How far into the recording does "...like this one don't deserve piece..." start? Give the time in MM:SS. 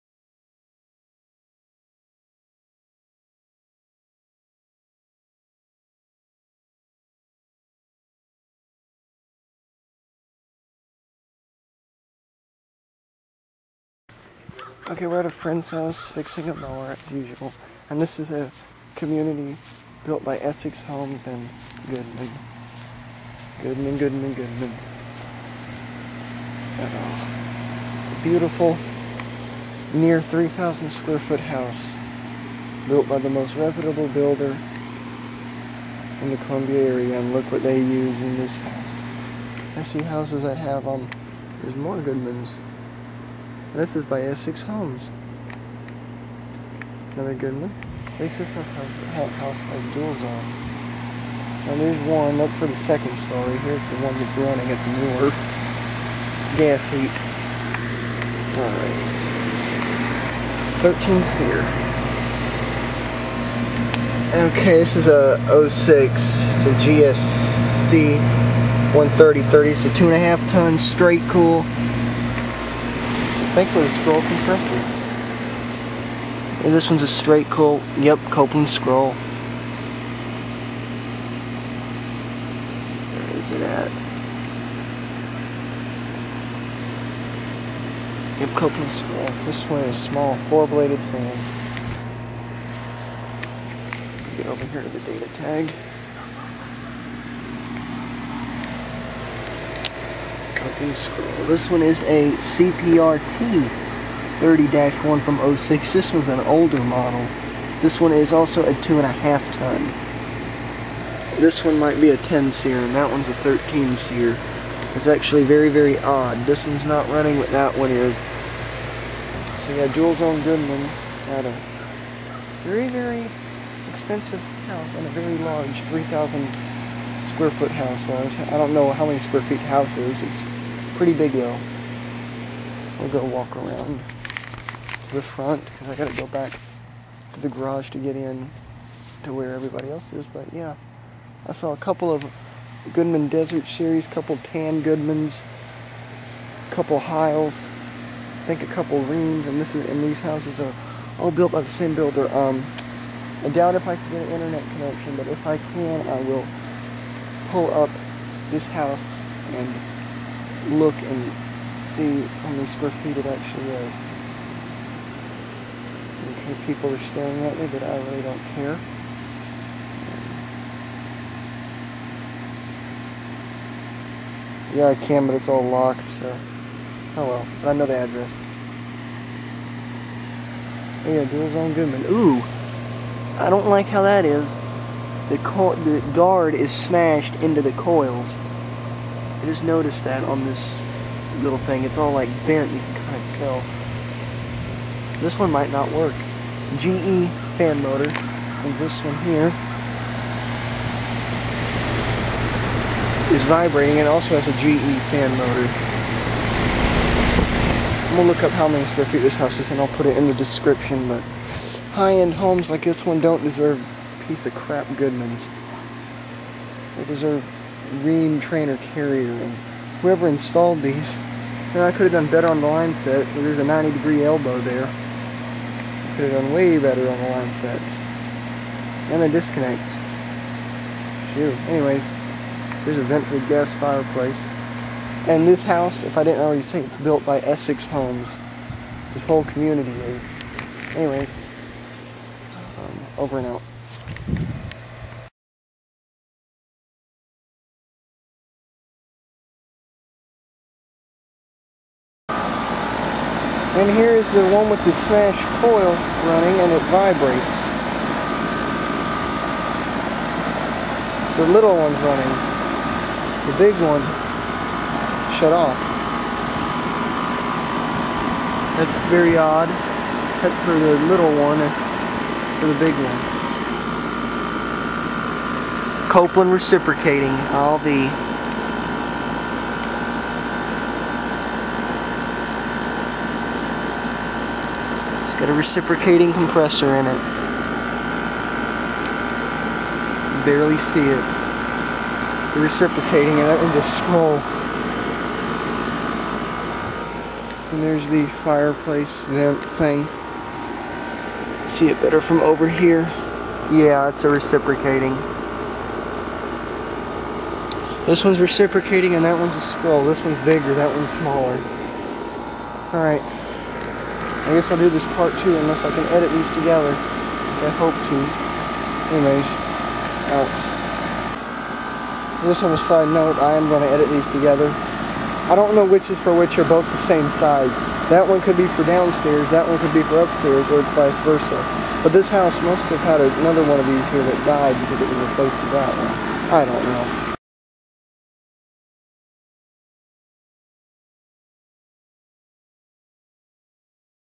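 03:32.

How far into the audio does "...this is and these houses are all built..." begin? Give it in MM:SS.
02:29.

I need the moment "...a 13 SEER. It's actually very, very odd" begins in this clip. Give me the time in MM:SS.
01:53.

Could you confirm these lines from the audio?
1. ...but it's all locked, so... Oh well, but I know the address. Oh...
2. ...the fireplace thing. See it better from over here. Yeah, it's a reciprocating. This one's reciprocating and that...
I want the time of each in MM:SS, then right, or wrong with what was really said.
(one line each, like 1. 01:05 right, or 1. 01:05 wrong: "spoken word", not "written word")
1. 02:55 right
2. 04:58 right.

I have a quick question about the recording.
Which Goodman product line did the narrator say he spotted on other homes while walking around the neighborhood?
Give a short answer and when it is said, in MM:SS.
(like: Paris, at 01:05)
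Desert Series, at 02:22.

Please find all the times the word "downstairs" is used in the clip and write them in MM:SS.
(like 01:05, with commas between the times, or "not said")
05:28.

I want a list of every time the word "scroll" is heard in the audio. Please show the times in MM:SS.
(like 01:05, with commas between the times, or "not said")
01:13, 01:18, 01:28, 01:40, 05:09.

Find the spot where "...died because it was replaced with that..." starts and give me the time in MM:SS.
05:34.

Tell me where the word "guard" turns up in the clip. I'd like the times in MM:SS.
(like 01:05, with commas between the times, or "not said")
03:06.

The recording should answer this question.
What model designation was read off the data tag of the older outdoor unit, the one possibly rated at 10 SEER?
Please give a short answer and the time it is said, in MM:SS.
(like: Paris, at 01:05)
CPRT 30-1, at 01:42.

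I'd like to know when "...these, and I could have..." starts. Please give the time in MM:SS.
03:40.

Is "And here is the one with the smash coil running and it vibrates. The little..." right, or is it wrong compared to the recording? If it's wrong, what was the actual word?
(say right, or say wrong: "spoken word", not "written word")
right.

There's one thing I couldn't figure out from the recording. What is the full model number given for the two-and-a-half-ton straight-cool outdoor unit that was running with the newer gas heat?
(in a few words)
GSC 130/30.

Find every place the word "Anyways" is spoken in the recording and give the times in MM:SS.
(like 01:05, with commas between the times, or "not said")
03:51, 04:00, 05:19.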